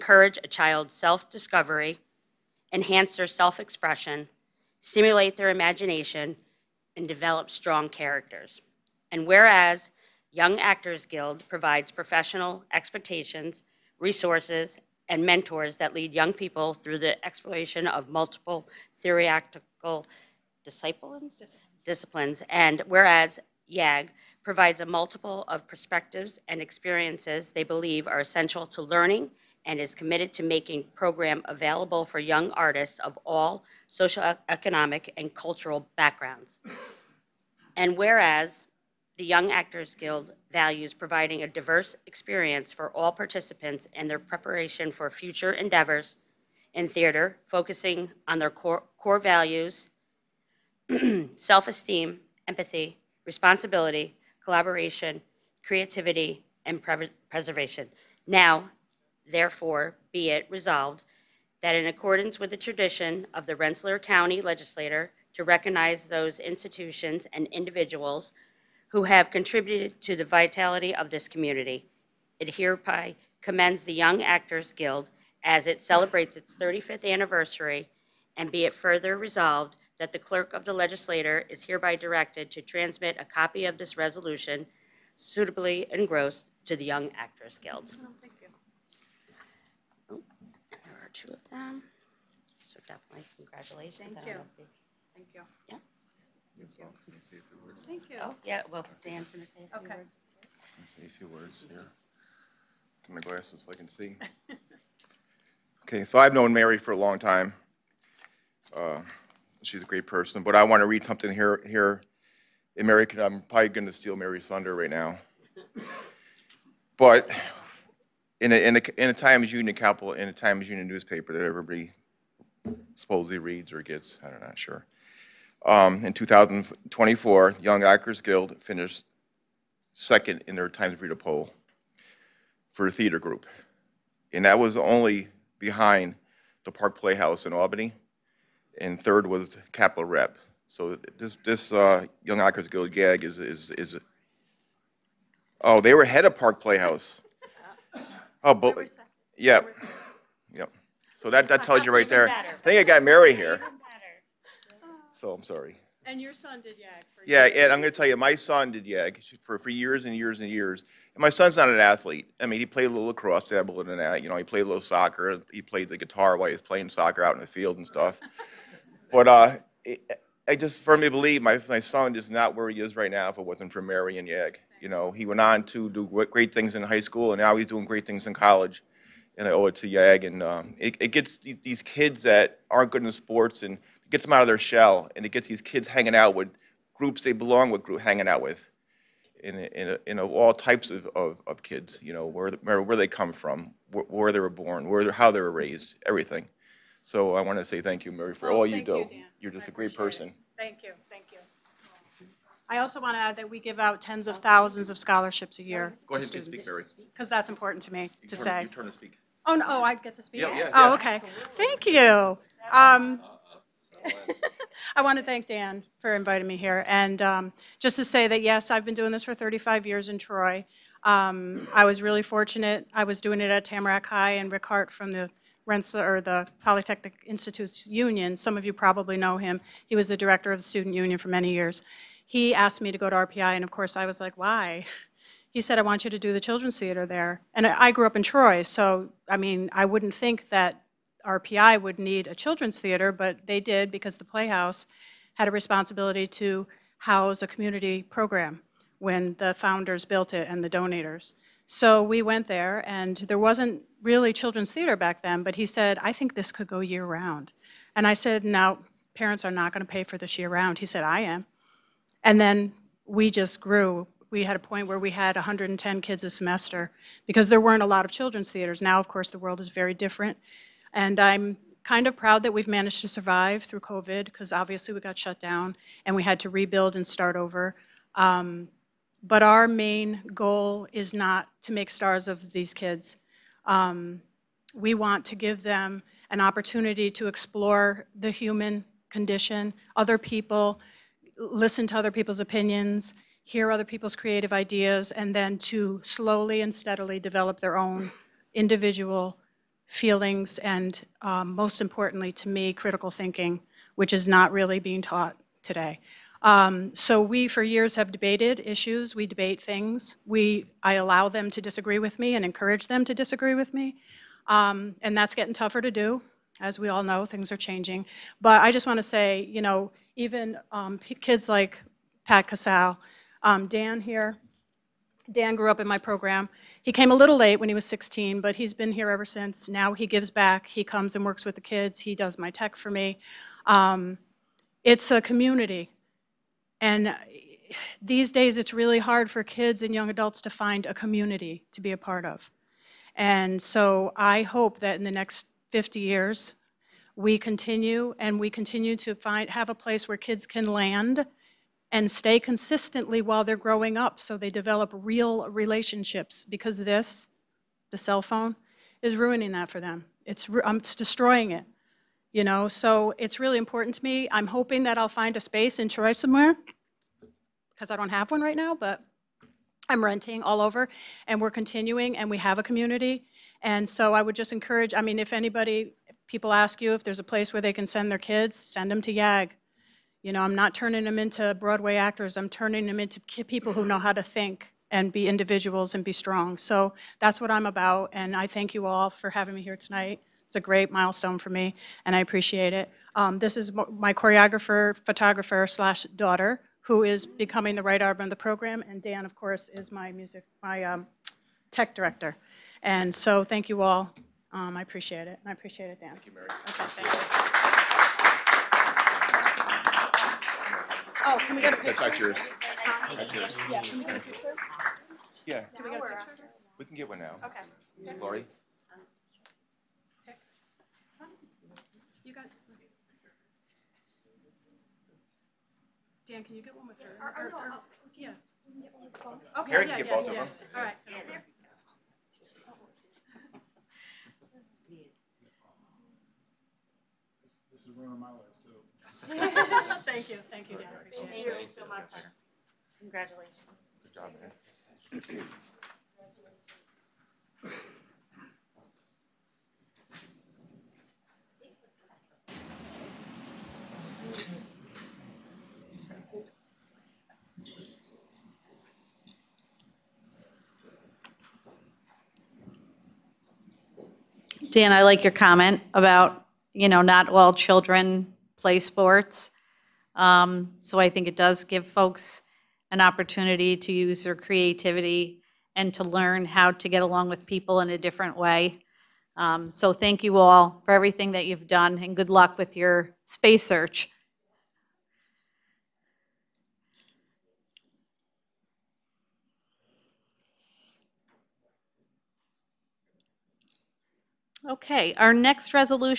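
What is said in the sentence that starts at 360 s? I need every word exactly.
It's, um, it's destroying it, you know?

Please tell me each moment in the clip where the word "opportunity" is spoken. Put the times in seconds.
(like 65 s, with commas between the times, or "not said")
286 s, 472 s.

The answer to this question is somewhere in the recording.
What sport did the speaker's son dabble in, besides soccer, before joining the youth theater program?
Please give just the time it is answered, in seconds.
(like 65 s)
163 s.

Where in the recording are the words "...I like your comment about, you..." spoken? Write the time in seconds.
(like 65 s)
464 s.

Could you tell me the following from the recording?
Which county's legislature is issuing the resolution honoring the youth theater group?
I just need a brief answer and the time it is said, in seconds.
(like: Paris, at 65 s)
Rensselaer County, at 63 s.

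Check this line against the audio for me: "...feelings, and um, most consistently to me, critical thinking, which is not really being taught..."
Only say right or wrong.
wrong.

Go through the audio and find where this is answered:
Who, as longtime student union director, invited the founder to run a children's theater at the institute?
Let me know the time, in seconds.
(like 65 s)
224 s.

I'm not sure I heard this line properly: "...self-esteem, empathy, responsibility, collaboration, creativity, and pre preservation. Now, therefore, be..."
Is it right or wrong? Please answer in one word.
right.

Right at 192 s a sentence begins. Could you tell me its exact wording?
You know where where they come from, where, where they were born, where how they were raised, everything.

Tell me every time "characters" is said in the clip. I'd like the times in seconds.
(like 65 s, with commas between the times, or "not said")
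7 s.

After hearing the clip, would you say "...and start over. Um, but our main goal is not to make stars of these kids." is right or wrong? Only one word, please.
right.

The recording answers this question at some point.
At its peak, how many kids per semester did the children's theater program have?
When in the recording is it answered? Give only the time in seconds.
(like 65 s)
265 s.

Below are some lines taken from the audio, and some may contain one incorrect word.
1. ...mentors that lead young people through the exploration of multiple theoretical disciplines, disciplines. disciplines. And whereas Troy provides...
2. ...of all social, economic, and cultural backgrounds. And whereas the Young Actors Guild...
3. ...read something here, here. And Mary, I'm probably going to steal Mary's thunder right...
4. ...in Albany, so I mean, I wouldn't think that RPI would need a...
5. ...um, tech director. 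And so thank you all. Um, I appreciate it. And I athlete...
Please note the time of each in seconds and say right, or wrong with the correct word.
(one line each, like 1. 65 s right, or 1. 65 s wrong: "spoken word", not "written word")
1. 15 s wrong: "YAG", not "Troy"
2. 32 s right
3. 110 s right
4. 238 s wrong: "Troy", not "Albany"
5. 400 s wrong: "appreciate", not "athlete".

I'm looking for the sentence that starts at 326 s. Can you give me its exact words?
He came a little late when he was 16, but he's been here ever since.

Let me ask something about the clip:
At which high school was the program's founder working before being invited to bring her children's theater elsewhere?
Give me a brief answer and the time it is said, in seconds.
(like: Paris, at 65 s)
Tamarac High, at 223 s.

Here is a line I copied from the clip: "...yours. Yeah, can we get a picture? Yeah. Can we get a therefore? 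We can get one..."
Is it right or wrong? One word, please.
wrong.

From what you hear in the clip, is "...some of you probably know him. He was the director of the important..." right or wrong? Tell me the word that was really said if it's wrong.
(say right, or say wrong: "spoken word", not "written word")
wrong: "student", not "important".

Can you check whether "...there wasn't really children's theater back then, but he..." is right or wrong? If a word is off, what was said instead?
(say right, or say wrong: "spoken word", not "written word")
right.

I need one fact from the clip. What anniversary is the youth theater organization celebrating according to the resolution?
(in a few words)
35th.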